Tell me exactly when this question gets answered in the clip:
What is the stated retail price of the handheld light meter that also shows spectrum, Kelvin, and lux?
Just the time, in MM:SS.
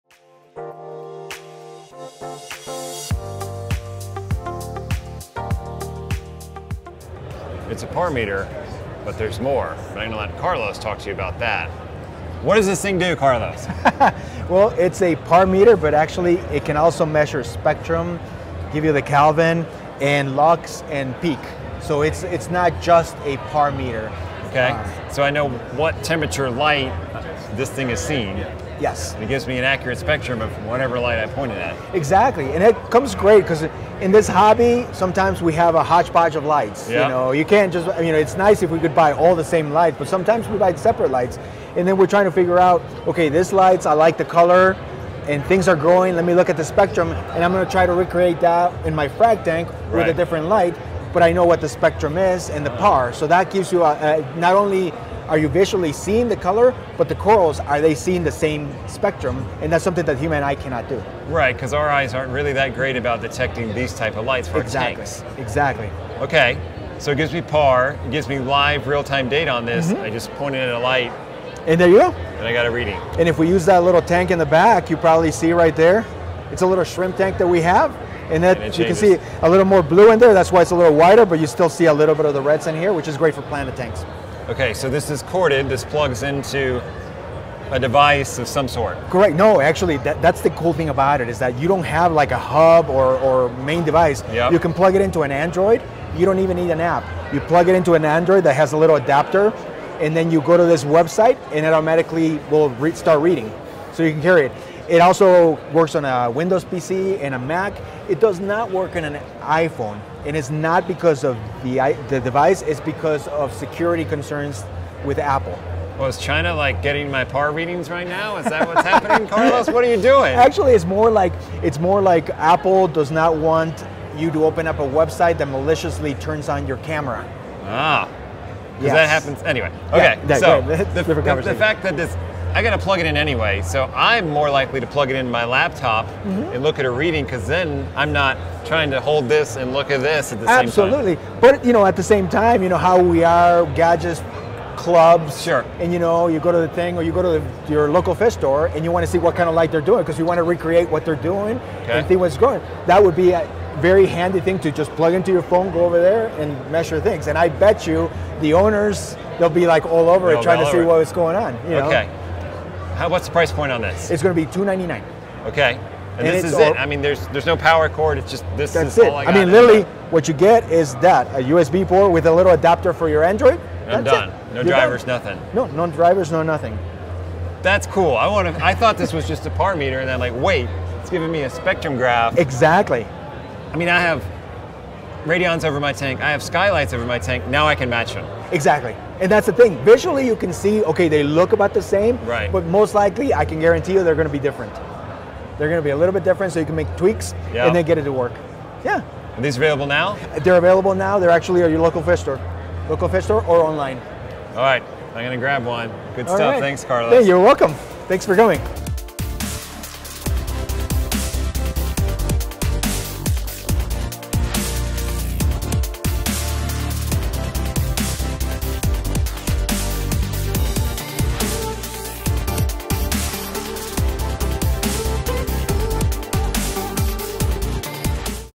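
02:44.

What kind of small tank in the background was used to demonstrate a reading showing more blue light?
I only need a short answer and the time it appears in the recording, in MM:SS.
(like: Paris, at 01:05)
Shrimp tank, at 01:16.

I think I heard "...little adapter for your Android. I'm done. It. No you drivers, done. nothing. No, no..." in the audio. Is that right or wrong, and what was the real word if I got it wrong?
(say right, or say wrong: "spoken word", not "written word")
right.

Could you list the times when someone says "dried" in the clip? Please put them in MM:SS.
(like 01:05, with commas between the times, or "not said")
not said.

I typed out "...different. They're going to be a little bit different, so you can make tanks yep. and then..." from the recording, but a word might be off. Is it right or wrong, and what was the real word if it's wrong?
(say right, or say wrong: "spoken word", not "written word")
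wrong: "tweaks", not "tanks".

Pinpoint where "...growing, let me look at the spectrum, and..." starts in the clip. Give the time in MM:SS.
00:45.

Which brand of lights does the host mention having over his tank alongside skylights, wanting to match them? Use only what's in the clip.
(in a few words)
Radion.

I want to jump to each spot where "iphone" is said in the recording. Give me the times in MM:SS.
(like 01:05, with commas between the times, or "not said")
01:49.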